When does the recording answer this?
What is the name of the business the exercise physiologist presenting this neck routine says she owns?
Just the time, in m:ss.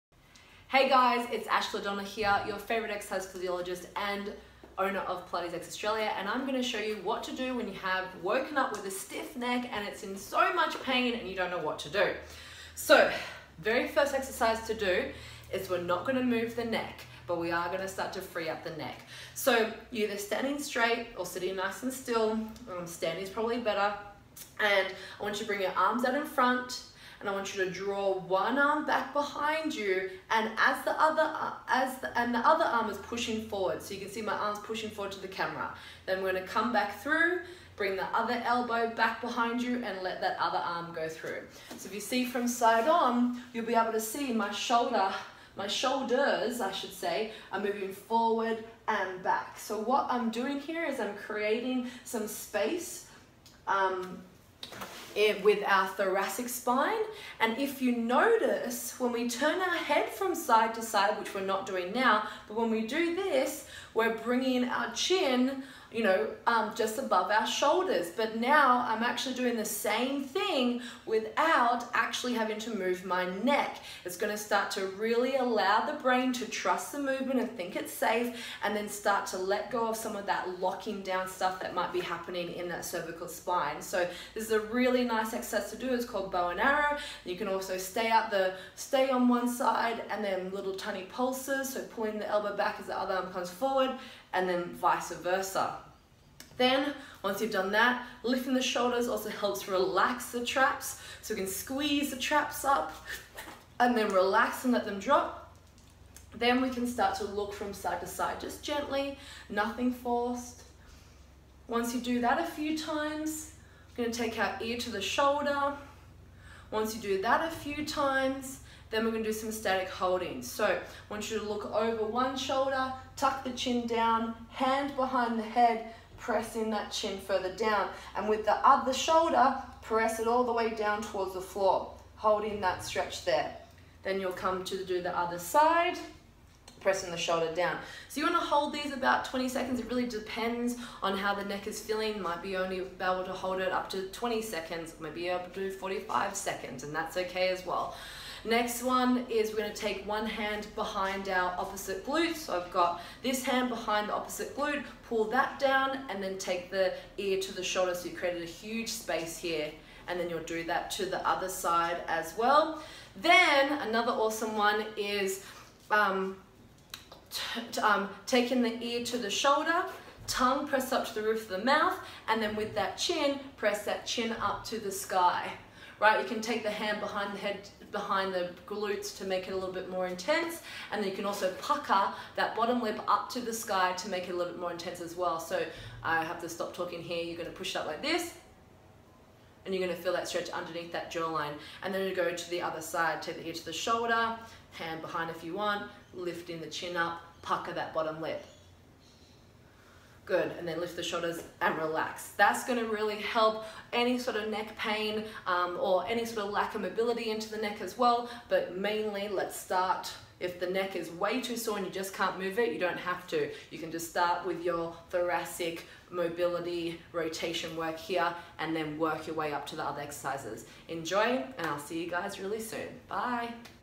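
0:05.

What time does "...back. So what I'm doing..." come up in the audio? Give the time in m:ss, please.
0:49.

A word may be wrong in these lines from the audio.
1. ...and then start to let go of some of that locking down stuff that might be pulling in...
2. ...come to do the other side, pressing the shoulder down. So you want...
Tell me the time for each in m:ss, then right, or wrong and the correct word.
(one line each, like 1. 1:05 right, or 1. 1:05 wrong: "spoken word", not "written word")
1. 1:18 wrong: "happening", not "pulling"
2. 2:14 right.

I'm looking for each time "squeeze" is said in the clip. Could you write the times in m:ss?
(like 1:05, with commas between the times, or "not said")
1:41.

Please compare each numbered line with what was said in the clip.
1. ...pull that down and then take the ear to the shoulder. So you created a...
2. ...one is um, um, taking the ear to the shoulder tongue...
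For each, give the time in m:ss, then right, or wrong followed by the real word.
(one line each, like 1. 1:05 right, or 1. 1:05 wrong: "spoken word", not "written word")
1. 2:35 right
2. 2:44 right.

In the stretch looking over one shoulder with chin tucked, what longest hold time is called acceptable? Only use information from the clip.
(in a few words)
45 seconds.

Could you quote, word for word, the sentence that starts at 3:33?
You can just start with your thoracic mobility rotation work here and then work your way up to the other exercises.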